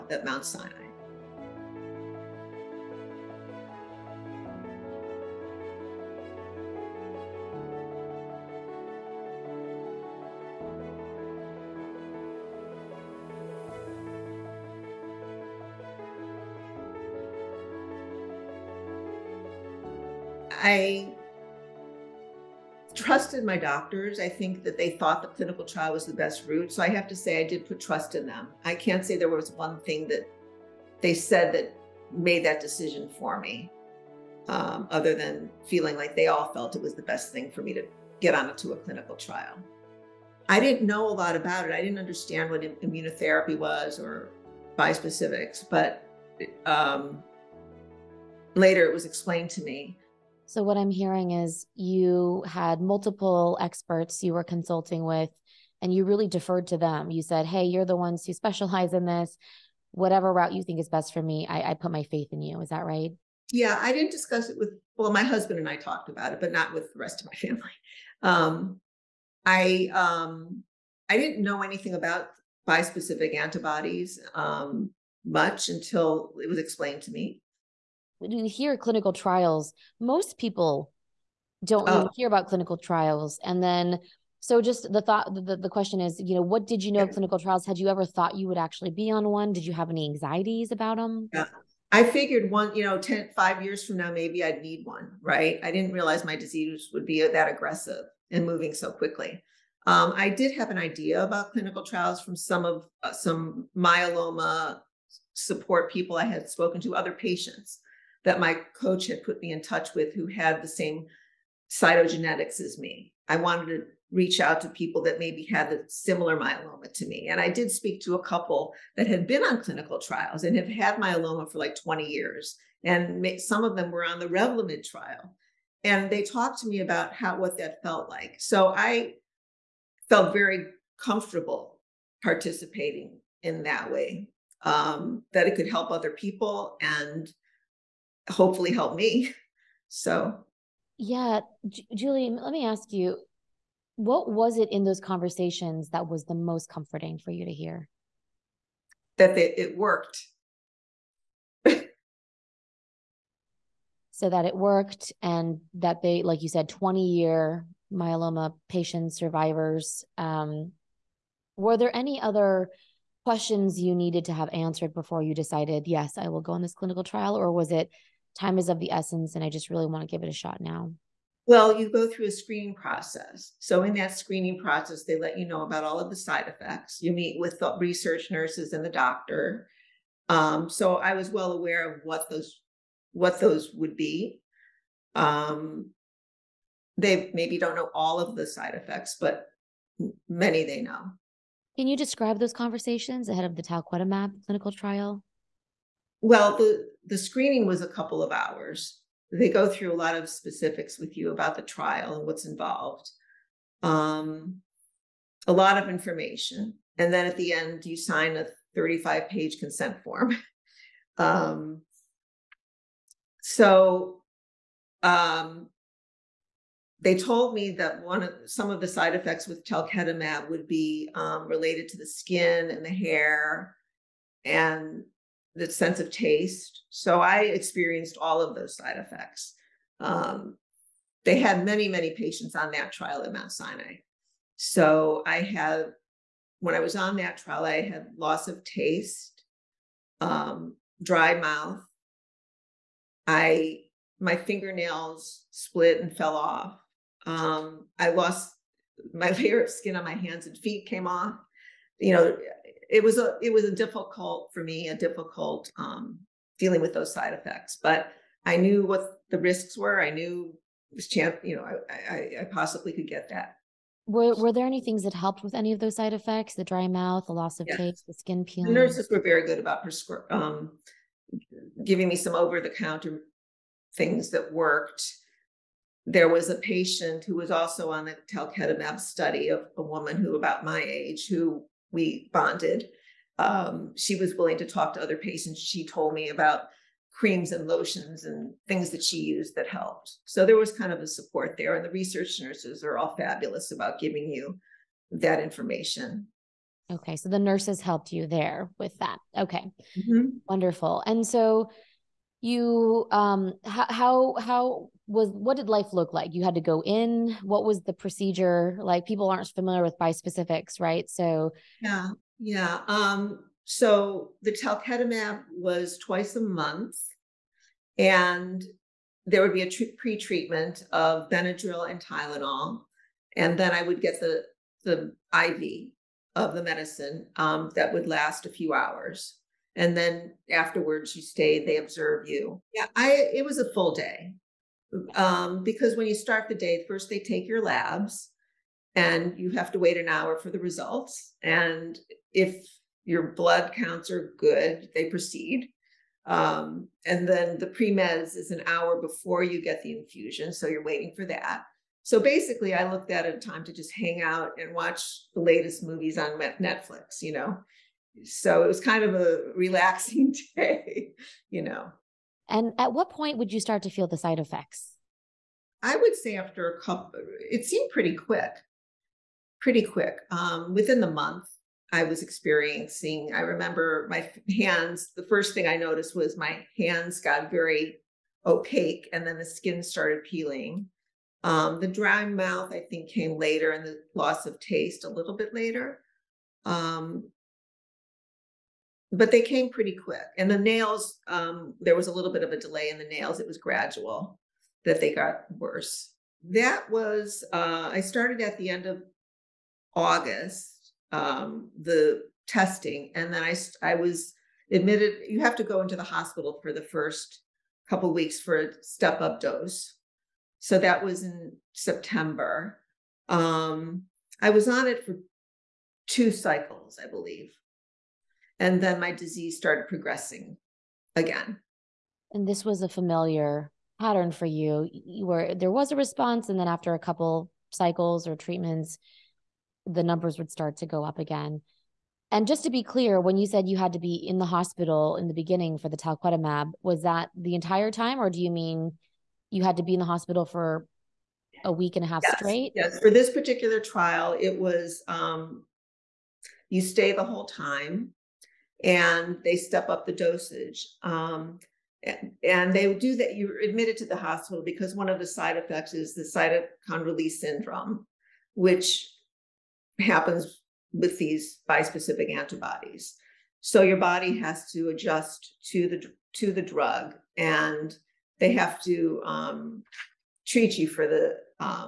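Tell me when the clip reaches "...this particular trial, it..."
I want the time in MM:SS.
07:23.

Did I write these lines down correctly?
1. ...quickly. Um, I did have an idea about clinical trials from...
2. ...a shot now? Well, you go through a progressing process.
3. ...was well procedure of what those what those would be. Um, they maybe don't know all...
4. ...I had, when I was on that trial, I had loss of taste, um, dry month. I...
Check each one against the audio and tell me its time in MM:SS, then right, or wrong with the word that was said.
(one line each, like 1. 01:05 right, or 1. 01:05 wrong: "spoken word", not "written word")
1. 01:38 right
2. 02:50 wrong: "screening", not "progressing"
3. 03:01 wrong: "aware", not "procedure"
4. 03:55 wrong: "mouth", not "month".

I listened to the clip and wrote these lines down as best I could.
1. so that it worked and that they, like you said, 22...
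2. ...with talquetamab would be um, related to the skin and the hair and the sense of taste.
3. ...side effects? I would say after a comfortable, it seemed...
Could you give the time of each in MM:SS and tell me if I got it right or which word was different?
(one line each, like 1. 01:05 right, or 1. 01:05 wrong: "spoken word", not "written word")
1. 02:34 wrong: "20", not "22"
2. 03:39 right
3. 06:04 wrong: "couple", not "comfortable".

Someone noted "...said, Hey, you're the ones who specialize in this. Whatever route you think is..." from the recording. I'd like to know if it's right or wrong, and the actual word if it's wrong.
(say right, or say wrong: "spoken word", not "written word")
right.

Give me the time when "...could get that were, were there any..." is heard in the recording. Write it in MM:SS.
04:22.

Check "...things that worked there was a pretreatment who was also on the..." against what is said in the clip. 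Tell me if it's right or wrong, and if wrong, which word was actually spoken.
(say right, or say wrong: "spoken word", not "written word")
wrong: "patient", not "pretreatment".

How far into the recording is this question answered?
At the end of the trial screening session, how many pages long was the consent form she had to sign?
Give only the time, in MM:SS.
03:28.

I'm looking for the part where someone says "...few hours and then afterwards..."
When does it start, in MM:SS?
05:28.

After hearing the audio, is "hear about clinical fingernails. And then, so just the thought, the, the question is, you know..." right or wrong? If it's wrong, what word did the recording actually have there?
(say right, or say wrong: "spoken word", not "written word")
wrong: "trials", not "fingernails".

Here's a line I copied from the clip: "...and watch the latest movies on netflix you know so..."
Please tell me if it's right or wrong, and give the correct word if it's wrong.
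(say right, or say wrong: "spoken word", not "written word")
right.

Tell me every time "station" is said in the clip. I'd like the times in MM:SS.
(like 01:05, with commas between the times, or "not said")
not said.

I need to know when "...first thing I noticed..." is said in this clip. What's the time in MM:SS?
06:15.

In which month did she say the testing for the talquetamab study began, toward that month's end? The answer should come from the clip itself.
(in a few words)
August.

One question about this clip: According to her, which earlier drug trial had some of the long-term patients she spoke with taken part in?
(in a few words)
Revlimid.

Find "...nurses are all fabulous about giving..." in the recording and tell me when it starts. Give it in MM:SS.
04:52.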